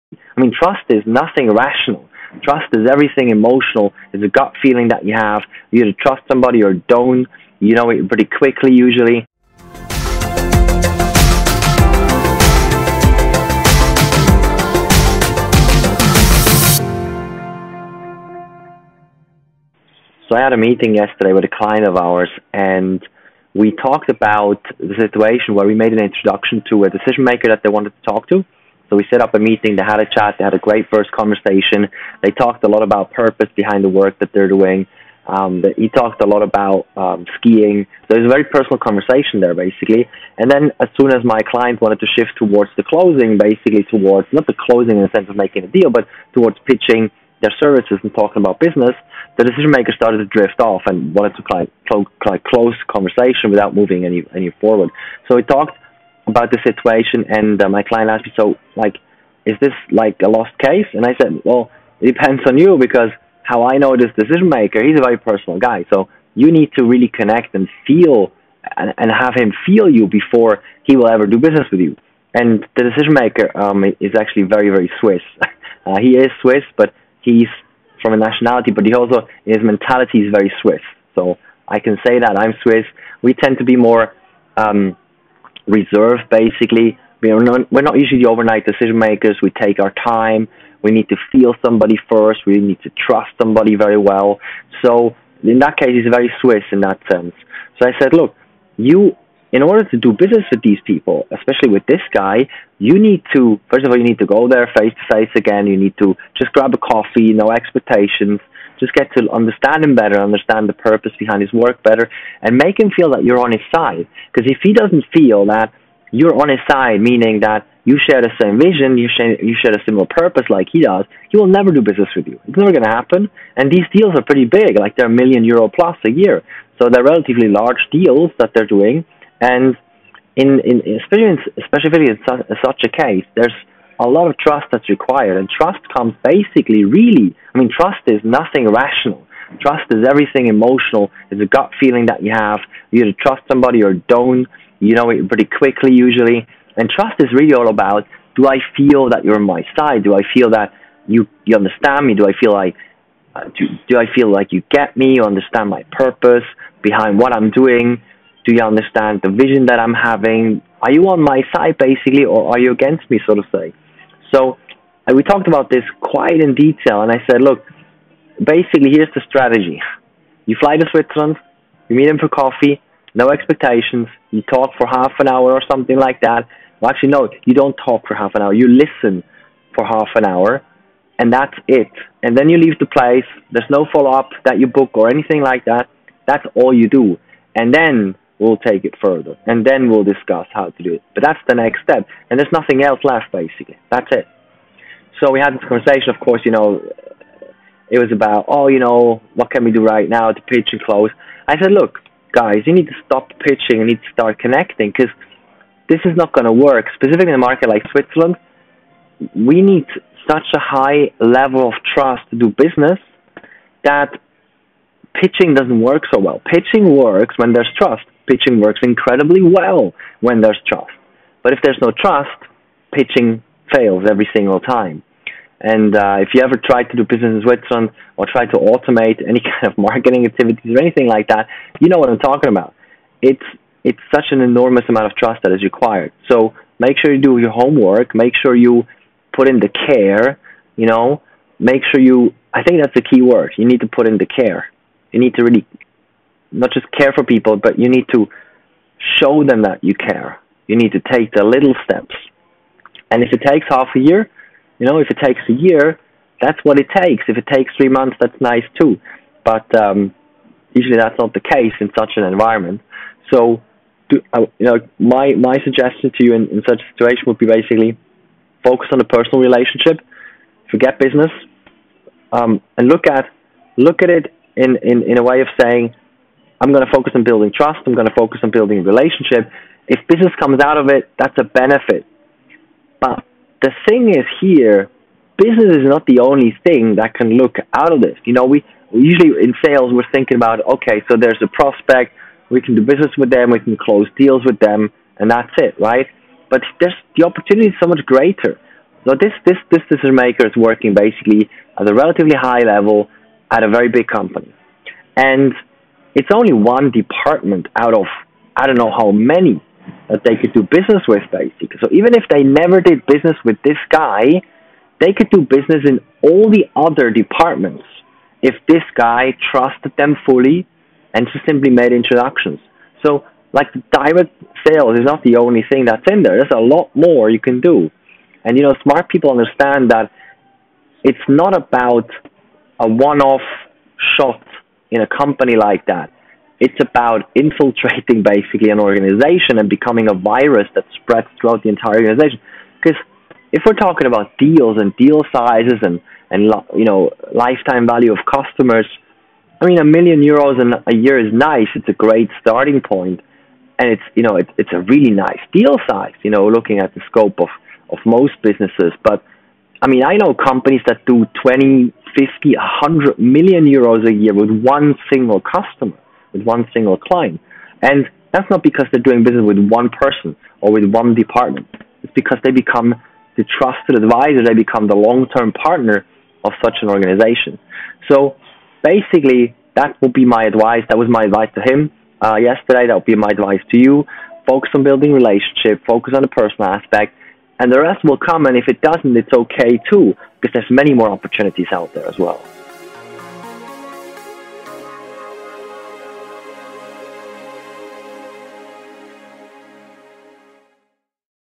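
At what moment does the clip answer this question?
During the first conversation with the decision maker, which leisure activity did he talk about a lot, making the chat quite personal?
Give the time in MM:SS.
00:37.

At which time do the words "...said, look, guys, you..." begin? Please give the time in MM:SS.
03:21.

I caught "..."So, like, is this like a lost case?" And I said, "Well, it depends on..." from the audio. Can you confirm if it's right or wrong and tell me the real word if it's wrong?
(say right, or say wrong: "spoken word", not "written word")
right.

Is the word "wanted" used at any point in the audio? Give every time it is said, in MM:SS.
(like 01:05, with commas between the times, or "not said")
00:27, 00:41, 00:51.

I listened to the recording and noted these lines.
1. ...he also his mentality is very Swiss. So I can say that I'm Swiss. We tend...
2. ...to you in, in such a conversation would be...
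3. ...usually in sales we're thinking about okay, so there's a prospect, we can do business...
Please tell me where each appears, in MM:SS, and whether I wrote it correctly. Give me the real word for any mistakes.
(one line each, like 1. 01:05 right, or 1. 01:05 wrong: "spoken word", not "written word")
1. 01:18 right
2. 04:26 wrong: "situation", not "conversation"
3. 04:48 right.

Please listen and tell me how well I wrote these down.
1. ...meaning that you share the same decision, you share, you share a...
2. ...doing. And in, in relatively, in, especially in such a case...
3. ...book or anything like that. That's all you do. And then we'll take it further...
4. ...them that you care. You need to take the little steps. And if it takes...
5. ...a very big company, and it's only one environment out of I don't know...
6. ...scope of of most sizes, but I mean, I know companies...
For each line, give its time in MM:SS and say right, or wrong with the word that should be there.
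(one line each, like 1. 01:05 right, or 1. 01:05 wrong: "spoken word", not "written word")
1. 01:56 wrong: "vision", not "decision"
2. 02:08 wrong: "especially", not "relatively"
3. 03:04 right
4. 04:09 right
5. 05:03 wrong: "department", not "environment"
6. 05:57 wrong: "businesses", not "sizes".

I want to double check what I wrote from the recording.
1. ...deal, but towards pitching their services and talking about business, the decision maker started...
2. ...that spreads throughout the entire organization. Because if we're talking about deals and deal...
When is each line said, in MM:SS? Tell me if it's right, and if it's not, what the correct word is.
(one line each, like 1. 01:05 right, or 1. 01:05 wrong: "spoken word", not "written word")
1. 00:45 right
2. 05:40 right.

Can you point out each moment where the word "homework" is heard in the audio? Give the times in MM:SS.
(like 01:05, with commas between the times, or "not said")
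03:57.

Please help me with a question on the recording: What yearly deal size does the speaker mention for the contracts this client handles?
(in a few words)
a million euro plus.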